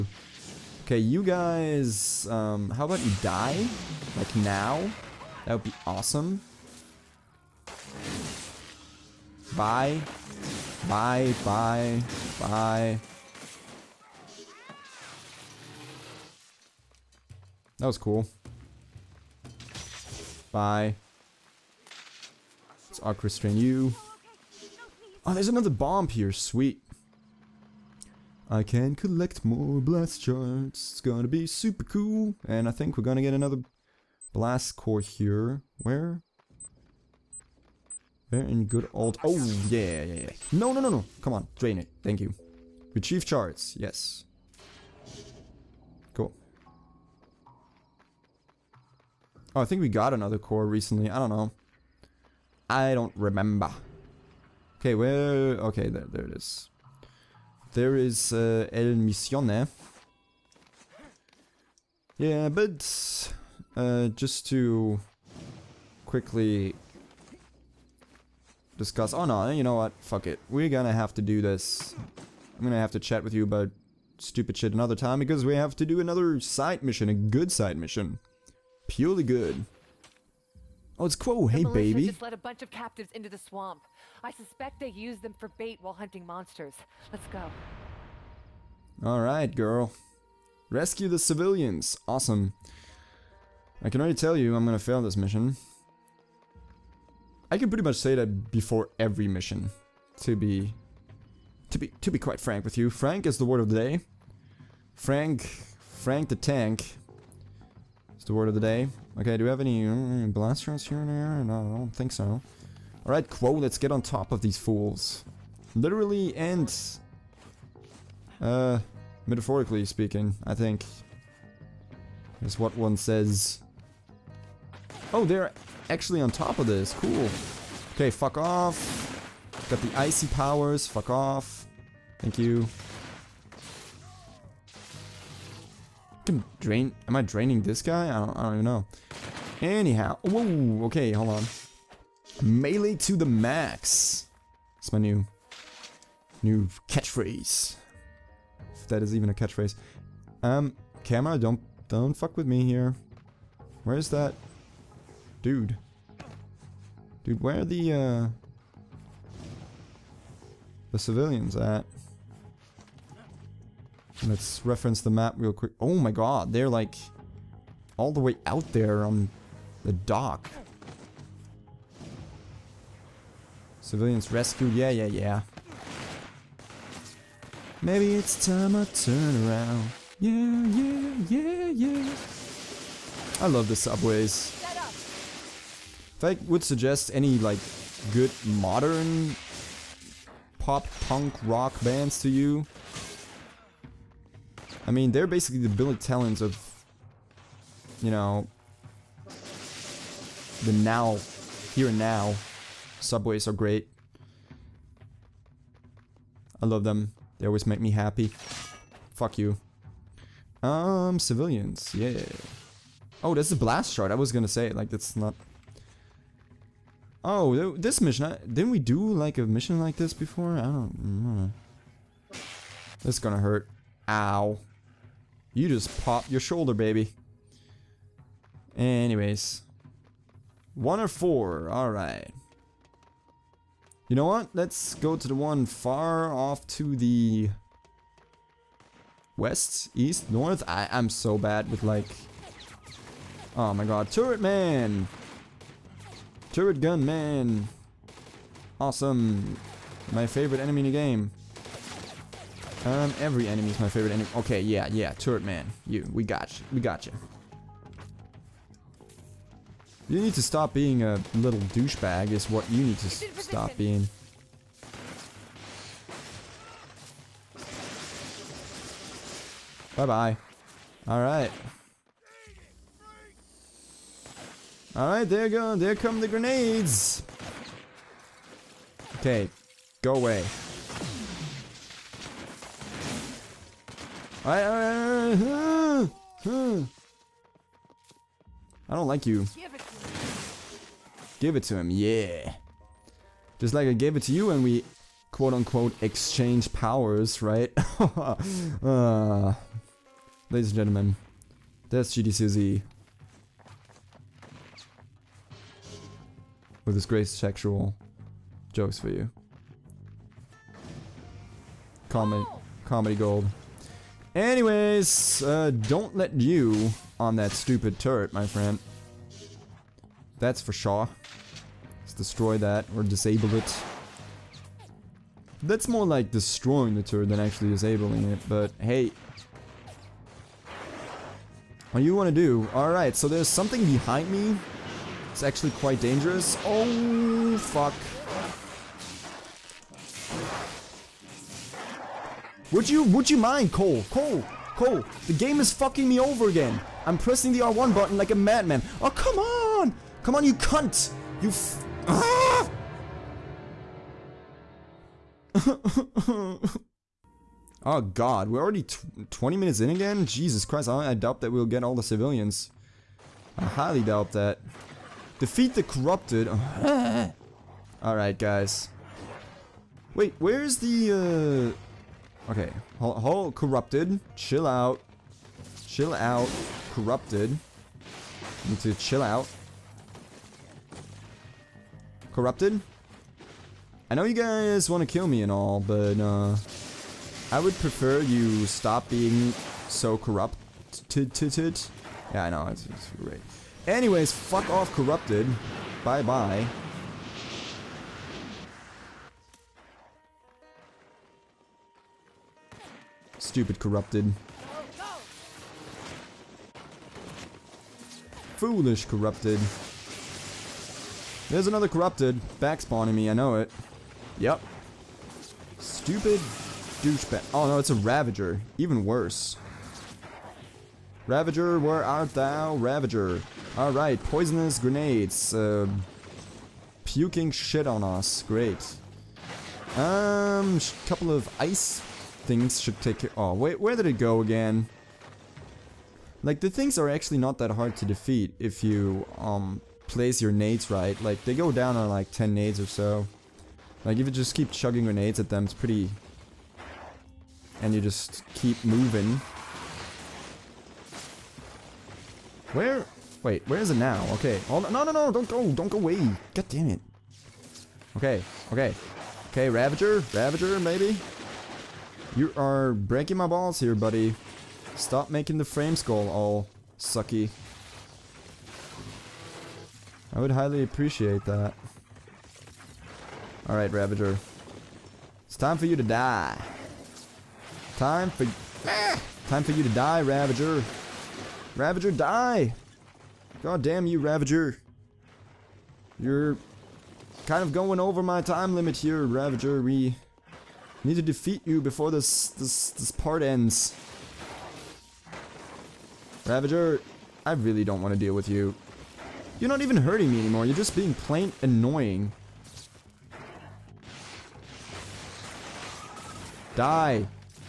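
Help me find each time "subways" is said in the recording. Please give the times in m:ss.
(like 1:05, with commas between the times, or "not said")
3:03, 3:23.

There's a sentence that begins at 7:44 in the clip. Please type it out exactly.
Stop making the frames go all sucky.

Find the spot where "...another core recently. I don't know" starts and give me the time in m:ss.
0:50.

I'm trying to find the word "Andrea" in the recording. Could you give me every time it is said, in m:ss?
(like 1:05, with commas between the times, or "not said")
not said.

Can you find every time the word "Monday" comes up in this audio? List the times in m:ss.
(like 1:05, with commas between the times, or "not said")
not said.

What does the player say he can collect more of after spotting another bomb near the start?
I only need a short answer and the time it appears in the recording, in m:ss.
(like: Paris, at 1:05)
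blast shards, at 0:29.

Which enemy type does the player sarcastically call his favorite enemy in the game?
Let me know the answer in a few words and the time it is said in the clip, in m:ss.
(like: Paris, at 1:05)
Turret gun man, at 4:06.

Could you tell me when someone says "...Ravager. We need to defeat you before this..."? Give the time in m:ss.
8:09.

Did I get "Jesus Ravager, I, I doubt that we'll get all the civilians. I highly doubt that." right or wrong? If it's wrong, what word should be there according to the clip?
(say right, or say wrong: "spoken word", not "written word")
wrong: "Christ", not "Ravager".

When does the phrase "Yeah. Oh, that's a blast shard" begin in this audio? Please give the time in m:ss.
3:31.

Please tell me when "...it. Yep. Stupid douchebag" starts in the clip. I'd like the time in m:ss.
6:53.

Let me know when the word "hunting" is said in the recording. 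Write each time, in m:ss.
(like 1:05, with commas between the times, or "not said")
1:25.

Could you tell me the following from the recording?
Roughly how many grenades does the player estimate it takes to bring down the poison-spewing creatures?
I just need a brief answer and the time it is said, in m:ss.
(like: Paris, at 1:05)
10, at 7:22.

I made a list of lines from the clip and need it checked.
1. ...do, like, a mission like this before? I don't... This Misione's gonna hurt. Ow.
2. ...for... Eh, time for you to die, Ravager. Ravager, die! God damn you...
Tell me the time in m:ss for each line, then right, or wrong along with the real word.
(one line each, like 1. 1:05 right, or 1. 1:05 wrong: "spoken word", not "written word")
1. 3:38 wrong: "That", not "Misione"
2. 7:58 right.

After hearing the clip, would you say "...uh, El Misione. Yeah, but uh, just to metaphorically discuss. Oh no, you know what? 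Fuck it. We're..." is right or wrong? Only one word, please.
wrong.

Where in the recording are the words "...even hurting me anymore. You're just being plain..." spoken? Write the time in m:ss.
8:19.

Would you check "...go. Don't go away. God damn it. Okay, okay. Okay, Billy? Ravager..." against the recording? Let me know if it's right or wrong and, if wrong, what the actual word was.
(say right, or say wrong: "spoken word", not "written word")
wrong: "Ravager", not "Billy".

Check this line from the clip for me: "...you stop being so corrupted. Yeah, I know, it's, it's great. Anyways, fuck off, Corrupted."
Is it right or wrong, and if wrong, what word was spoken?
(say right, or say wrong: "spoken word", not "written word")
right.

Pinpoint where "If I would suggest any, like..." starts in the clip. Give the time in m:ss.
3:04.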